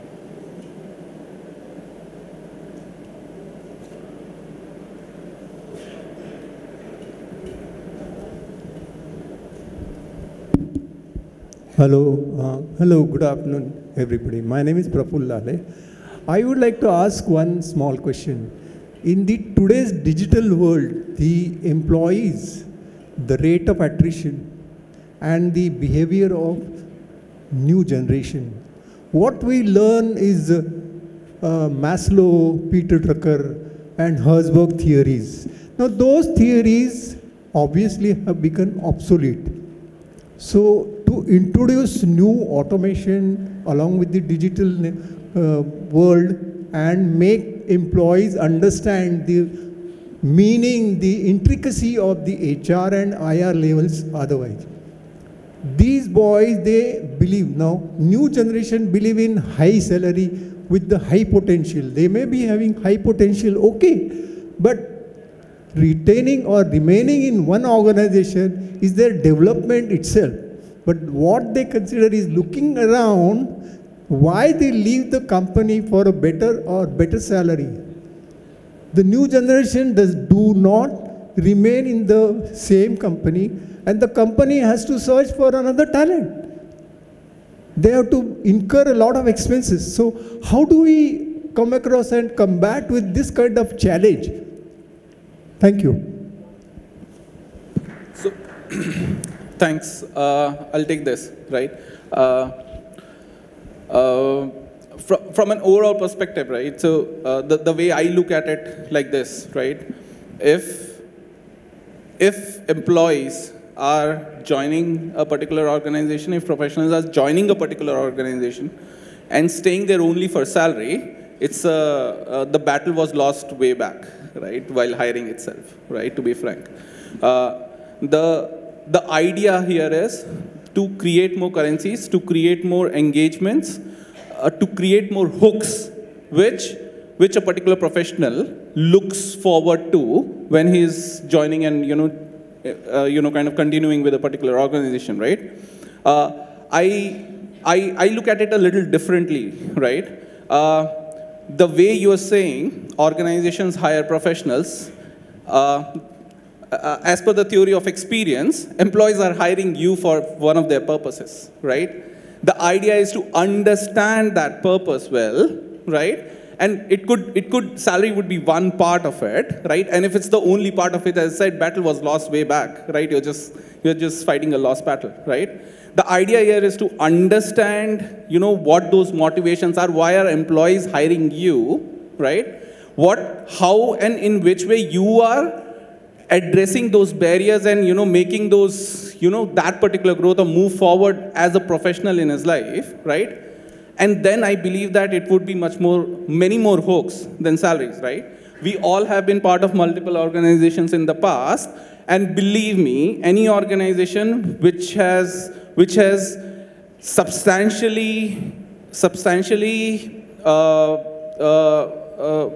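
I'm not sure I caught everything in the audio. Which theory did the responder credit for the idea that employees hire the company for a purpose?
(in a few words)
theory of experience.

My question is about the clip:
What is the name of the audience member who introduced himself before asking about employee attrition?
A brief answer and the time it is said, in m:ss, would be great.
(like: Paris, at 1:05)
Praful Lale, at 0:14.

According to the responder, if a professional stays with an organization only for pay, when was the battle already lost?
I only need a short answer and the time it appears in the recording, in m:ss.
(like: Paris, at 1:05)
While hiring, at 2:04.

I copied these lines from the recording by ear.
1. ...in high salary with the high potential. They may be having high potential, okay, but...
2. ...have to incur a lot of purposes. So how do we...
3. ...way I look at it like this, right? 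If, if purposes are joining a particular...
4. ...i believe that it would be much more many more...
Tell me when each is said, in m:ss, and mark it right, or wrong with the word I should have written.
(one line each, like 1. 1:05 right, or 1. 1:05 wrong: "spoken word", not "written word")
1. 0:59 right
2. 1:27 wrong: "expenses", not "purposes"
3. 1:47 wrong: "employees", not "purposes"
4. 3:14 right.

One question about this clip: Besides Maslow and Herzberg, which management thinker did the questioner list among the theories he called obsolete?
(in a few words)
Peter Drucker.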